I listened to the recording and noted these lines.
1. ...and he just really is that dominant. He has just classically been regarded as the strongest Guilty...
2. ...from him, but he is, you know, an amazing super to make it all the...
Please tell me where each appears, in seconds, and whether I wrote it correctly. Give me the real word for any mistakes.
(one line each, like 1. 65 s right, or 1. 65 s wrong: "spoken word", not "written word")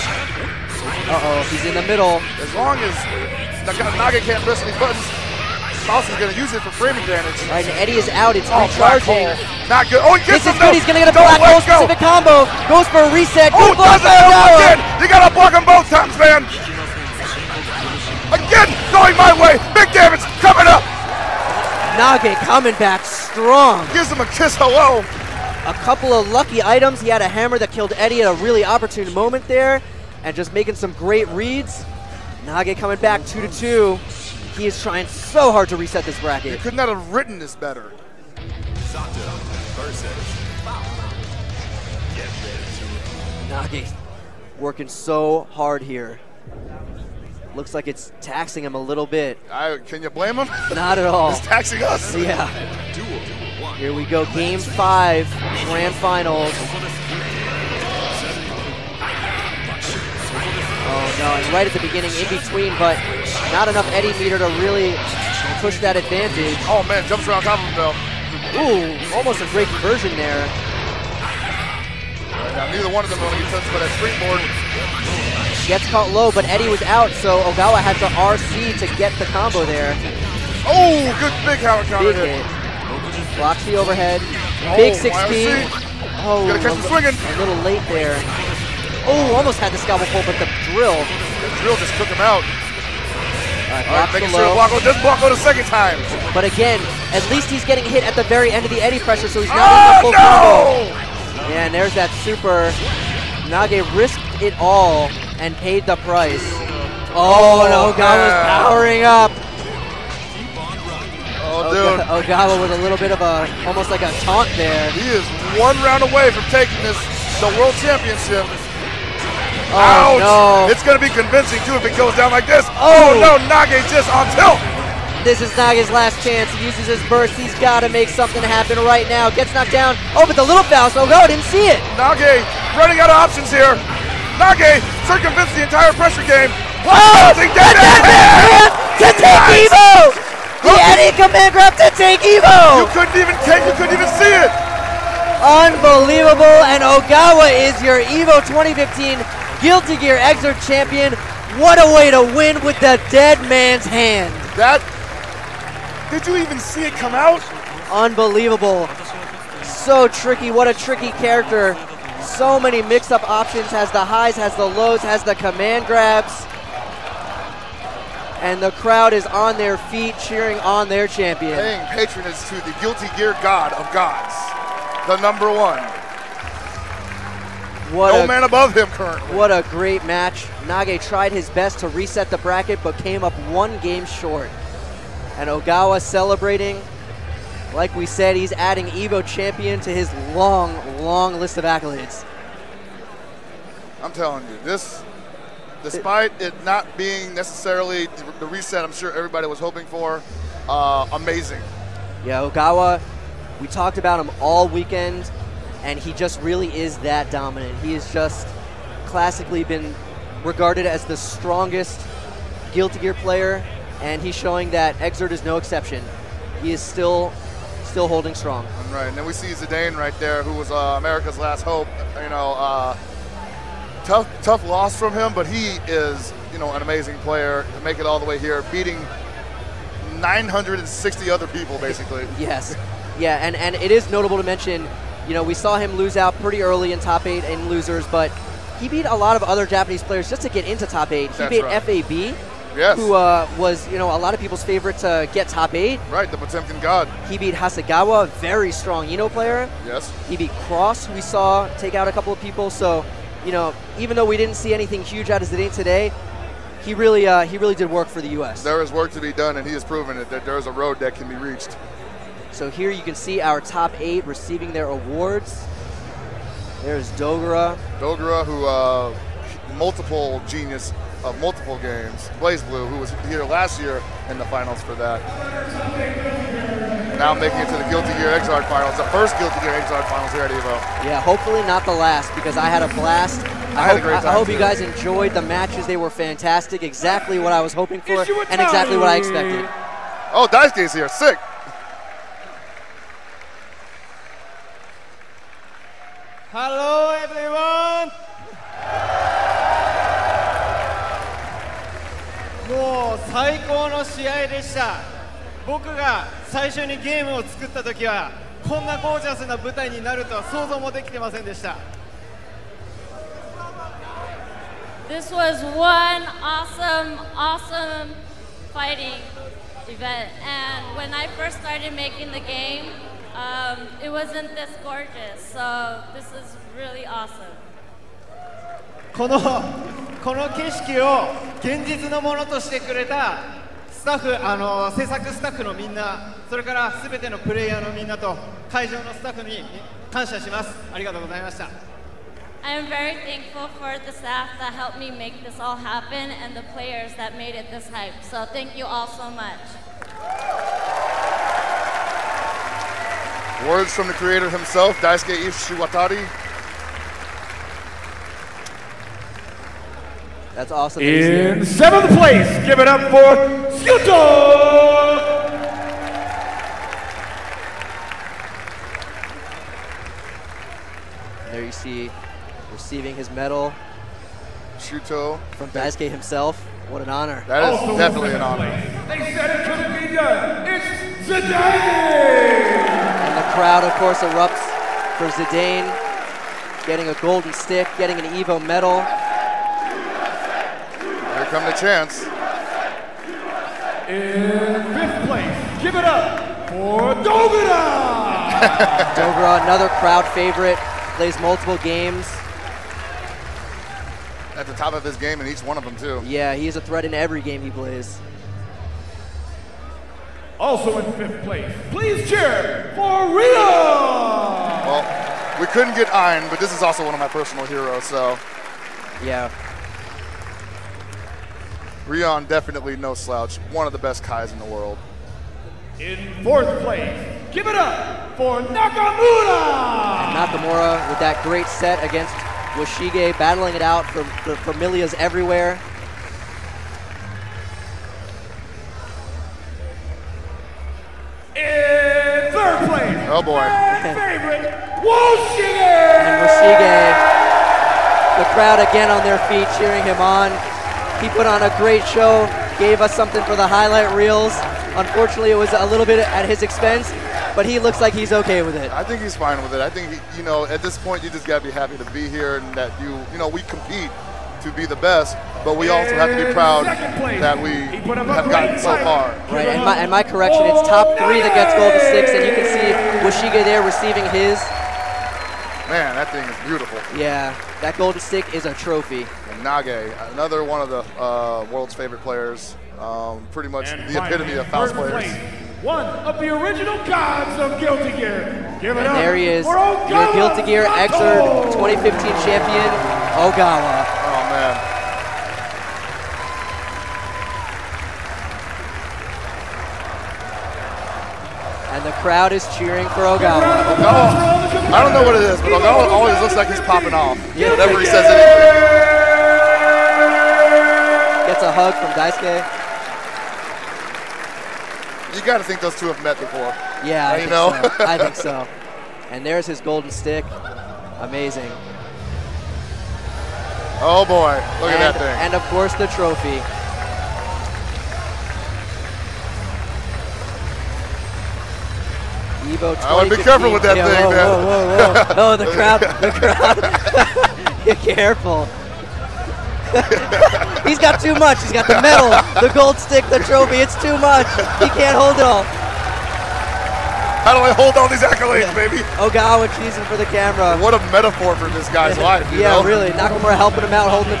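1. 205 s right
2. 224 s wrong: "player", not "super".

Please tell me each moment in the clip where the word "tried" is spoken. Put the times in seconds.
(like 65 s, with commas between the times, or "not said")
181 s.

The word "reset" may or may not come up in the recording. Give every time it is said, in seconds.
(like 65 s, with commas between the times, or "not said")
13 s, 35 s, 181 s, 198 s.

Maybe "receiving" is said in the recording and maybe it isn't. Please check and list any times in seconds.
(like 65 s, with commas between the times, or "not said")
264 s, 372 s, 473 s.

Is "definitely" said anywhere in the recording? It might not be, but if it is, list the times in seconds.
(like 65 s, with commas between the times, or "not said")
377 s, 422 s.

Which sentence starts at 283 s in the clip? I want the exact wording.
I, I had hope, a great time I hope you guys enjoyed the matches.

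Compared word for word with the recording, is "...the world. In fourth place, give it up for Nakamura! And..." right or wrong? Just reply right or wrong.
right.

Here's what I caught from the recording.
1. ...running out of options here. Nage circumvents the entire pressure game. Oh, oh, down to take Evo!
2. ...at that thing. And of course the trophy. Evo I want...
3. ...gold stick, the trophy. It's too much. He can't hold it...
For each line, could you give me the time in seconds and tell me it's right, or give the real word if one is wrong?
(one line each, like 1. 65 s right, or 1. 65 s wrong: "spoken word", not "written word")
1. 132 s right
2. 525 s right
3. 542 s right.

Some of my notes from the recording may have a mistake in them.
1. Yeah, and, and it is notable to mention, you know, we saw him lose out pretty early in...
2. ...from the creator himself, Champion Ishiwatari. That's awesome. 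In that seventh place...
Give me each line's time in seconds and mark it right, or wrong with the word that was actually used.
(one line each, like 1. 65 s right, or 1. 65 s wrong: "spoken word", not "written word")
1. 233 s right
2. 353 s wrong: "Daisuke", not "Champion".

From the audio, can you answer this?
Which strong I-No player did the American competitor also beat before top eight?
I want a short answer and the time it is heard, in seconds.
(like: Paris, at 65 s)
Hasegawa, at 247 s.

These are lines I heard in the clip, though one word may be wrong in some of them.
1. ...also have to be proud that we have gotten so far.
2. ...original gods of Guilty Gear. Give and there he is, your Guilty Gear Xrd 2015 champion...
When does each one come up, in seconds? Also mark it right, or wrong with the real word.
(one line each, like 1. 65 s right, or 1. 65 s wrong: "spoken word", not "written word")
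1. 465 s right
2. 486 s right.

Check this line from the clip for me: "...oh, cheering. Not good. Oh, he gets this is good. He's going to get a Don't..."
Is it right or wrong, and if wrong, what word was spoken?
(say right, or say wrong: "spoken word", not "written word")
wrong: "recharging", not "cheering".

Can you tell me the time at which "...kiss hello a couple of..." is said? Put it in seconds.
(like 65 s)
24 s.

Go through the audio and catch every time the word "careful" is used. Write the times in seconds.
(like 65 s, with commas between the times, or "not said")
533 s, 538 s.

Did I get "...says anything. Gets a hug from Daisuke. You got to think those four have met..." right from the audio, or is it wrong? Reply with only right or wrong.
wrong.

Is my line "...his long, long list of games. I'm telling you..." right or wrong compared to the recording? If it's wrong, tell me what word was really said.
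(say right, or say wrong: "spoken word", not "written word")
wrong: "accolades", not "games".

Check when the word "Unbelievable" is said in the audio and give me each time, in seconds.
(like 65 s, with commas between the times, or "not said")
145 s, 157 s.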